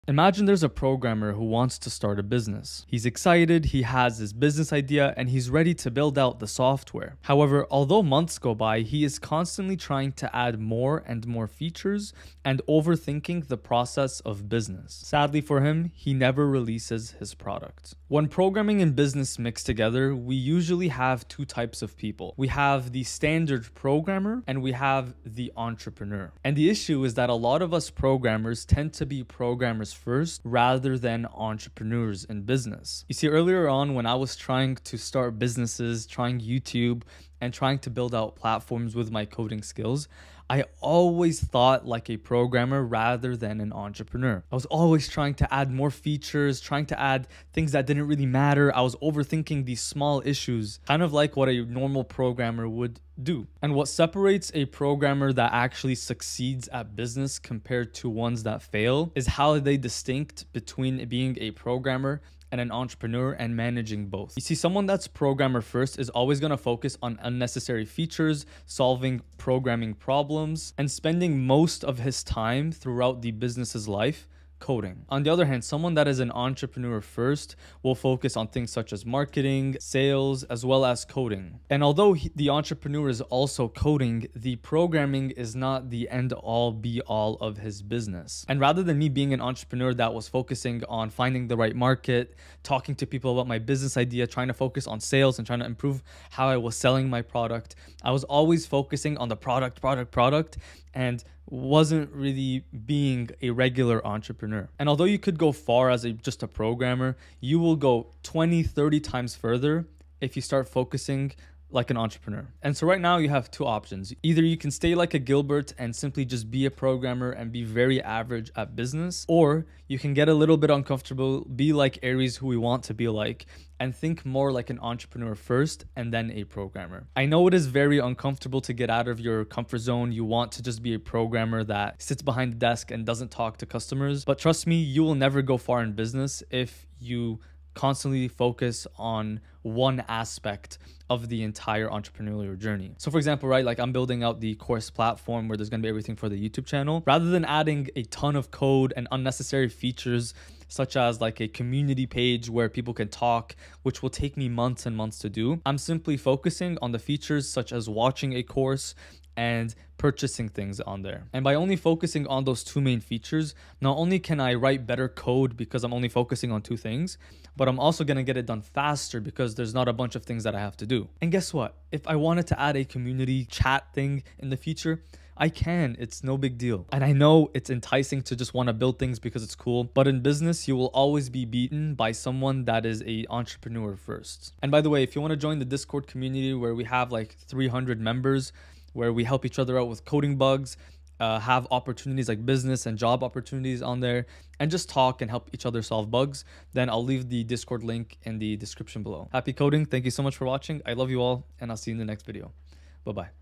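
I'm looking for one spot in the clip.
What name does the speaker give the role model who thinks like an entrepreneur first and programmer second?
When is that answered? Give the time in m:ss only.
2:02.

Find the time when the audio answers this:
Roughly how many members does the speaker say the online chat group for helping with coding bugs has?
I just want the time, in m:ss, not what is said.
3:07.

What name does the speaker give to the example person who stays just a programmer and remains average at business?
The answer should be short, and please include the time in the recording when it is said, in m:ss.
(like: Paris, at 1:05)
Gilbert, at 1:55.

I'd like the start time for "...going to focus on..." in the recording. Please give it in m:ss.
1:06.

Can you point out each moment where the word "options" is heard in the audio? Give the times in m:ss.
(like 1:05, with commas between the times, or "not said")
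1:53.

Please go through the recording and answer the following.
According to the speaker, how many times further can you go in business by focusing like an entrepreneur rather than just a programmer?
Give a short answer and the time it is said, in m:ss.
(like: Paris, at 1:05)
20, 30 times, at 1:48.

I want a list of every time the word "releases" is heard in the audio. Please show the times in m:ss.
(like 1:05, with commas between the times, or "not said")
0:16.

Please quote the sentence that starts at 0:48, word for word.
I was overthinking these small issues, kind of like what a normal programmer would do.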